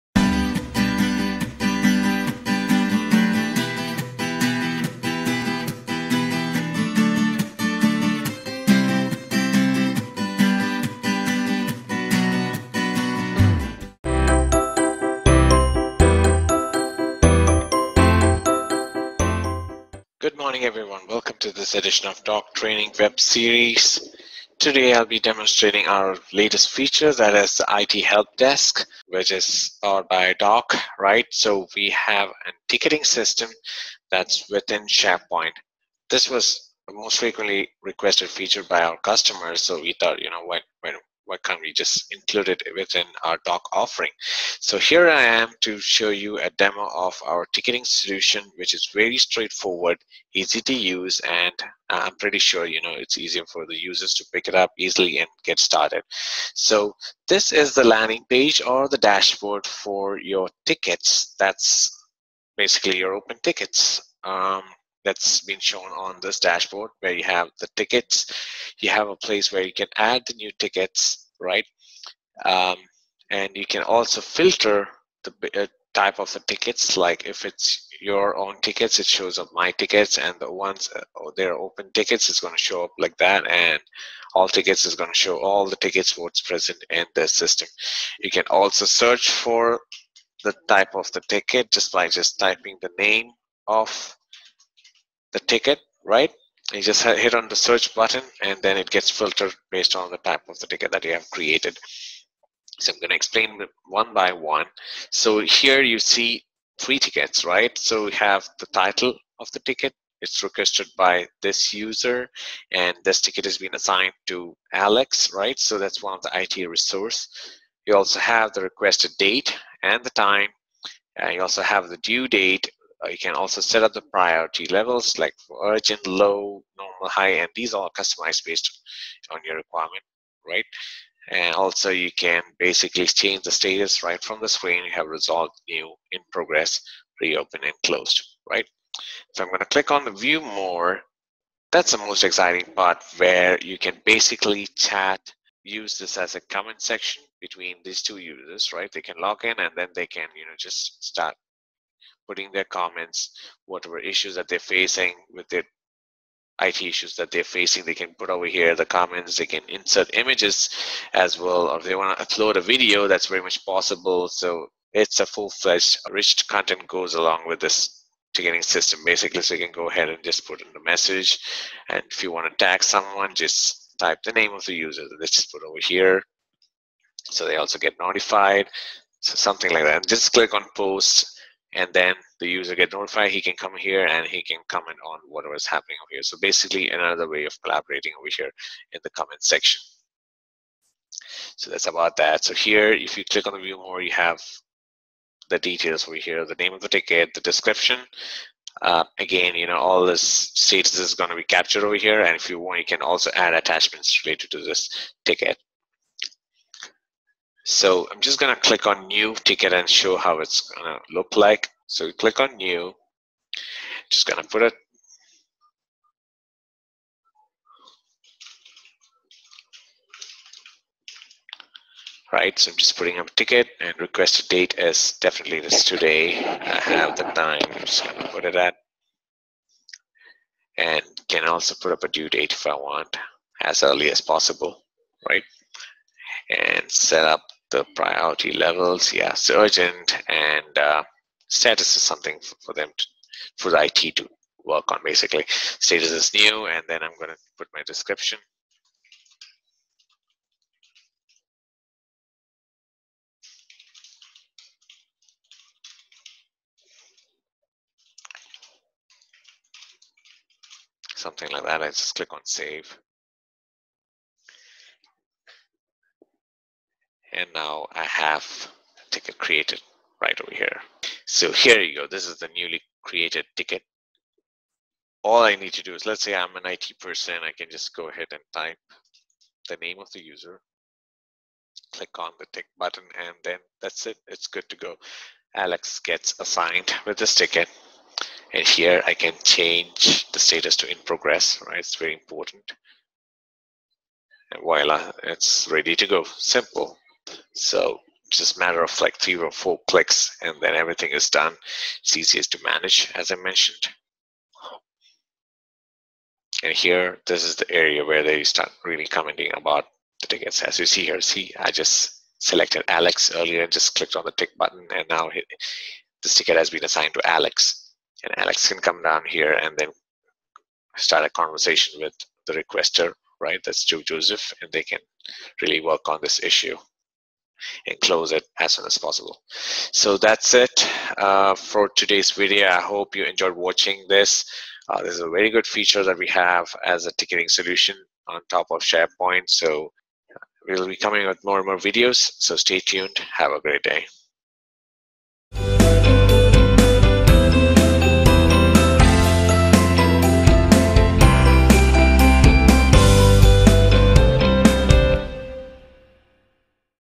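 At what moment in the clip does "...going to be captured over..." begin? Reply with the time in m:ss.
3:21.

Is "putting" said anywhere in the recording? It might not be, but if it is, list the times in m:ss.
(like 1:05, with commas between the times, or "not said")
2:32, 3:42.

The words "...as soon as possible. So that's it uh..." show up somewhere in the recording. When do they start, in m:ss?
5:28.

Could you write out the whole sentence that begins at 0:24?
Today, I'll be demonstrating our latest feature, that is the IT Help Desk, which is powered by Dock, right?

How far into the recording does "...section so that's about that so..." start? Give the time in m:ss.
3:09.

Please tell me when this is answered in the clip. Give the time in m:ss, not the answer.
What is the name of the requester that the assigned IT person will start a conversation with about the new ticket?
5:23.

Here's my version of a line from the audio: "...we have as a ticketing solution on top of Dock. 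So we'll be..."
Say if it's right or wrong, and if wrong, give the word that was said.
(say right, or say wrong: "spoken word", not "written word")
wrong: "SharePoint", not "Dock".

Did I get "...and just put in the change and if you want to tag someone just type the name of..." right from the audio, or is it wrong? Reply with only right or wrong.
wrong.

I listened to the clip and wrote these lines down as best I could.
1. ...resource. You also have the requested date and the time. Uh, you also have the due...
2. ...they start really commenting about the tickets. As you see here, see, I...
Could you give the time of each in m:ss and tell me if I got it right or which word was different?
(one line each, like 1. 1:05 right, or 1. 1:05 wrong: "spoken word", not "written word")
1. 1:56 right
2. 5:08 right.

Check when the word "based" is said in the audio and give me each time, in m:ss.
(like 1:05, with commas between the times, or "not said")
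1:39, 2:08.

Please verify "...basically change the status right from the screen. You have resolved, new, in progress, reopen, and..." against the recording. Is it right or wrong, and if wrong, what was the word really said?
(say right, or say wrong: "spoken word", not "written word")
right.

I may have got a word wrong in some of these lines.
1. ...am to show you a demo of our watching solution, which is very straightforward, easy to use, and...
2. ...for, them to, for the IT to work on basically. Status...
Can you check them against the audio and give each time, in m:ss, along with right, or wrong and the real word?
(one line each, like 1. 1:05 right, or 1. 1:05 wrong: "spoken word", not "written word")
1. 0:45 wrong: "ticketing", not "watching"
2. 4:02 right.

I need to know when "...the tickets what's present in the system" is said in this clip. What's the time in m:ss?
1:25.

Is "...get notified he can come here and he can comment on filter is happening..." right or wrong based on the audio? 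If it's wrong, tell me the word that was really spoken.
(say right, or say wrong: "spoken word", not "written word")
wrong: "whatever", not "filter".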